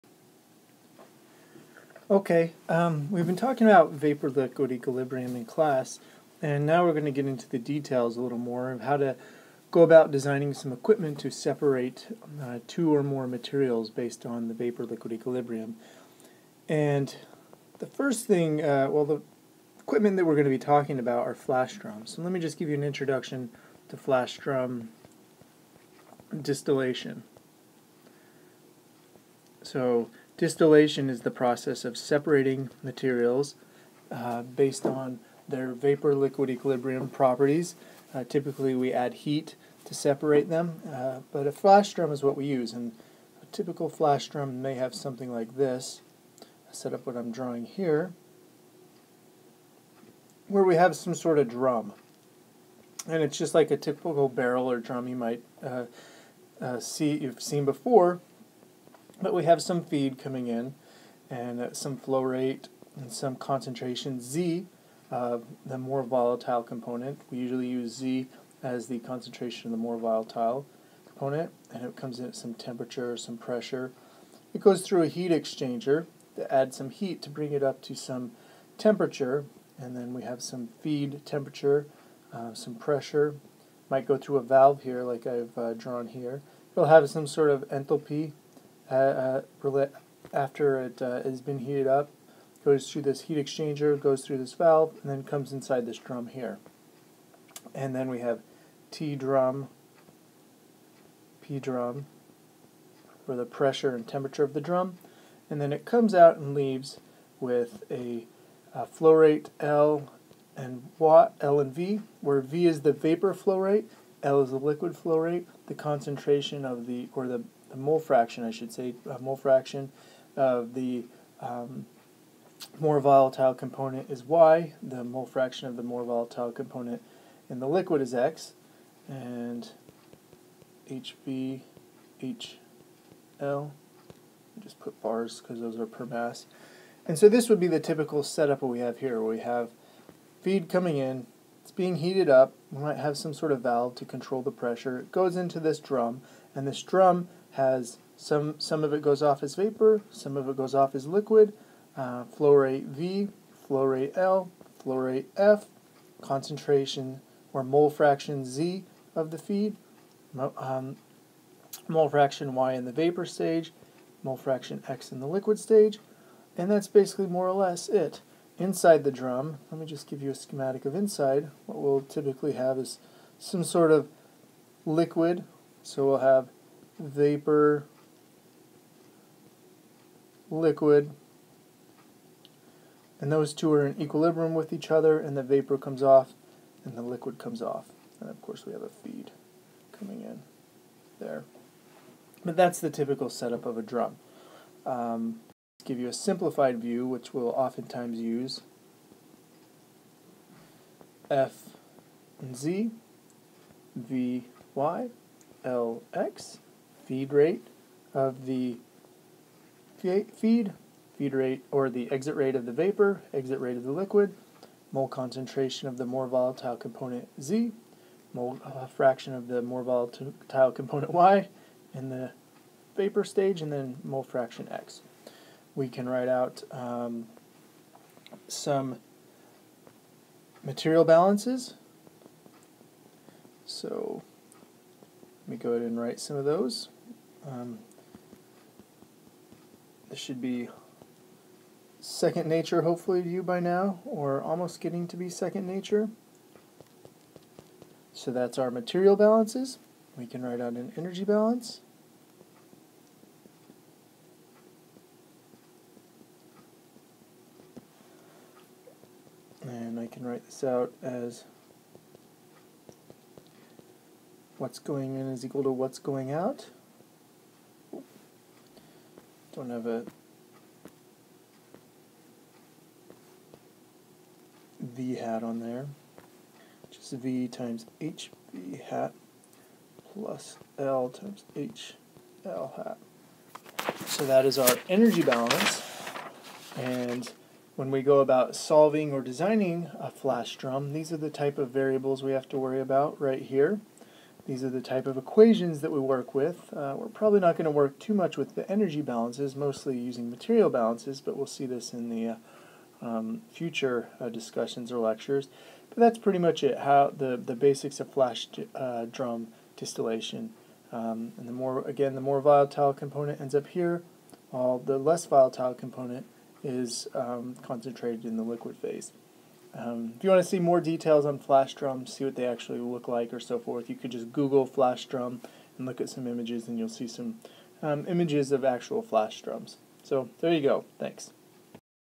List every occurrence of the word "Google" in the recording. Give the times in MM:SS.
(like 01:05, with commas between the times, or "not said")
05:24.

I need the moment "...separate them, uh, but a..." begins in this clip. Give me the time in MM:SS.
00:39.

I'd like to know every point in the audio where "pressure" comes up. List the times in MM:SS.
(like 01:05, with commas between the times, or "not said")
01:13, 01:22, 01:43, 02:24.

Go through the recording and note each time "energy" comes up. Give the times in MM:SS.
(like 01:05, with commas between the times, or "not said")
04:10, 04:44, 04:58.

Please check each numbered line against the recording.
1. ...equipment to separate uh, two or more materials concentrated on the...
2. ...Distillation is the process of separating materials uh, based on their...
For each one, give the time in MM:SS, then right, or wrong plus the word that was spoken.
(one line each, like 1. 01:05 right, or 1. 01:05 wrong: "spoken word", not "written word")
1. 00:10 wrong: "based", not "concentrated"
2. 00:30 right.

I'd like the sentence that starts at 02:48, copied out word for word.
Inside the drum, let me just give you a schematic of inside.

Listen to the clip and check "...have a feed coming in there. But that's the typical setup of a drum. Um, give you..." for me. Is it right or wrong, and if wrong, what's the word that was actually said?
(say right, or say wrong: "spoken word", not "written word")
right.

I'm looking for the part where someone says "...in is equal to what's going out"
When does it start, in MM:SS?
04:25.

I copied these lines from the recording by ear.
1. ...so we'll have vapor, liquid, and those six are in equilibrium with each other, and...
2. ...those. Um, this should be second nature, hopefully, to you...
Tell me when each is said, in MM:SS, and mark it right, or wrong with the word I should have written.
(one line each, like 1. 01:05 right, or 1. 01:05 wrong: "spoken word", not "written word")
1. 02:55 wrong: "two", not "six"
2. 03:56 right.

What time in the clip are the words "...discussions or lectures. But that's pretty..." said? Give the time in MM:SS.
05:04.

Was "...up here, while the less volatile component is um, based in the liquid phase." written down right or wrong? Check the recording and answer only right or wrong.
wrong.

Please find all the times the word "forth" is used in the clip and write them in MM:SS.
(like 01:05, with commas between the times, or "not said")
05:23.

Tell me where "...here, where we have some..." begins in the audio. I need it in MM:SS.
00:47.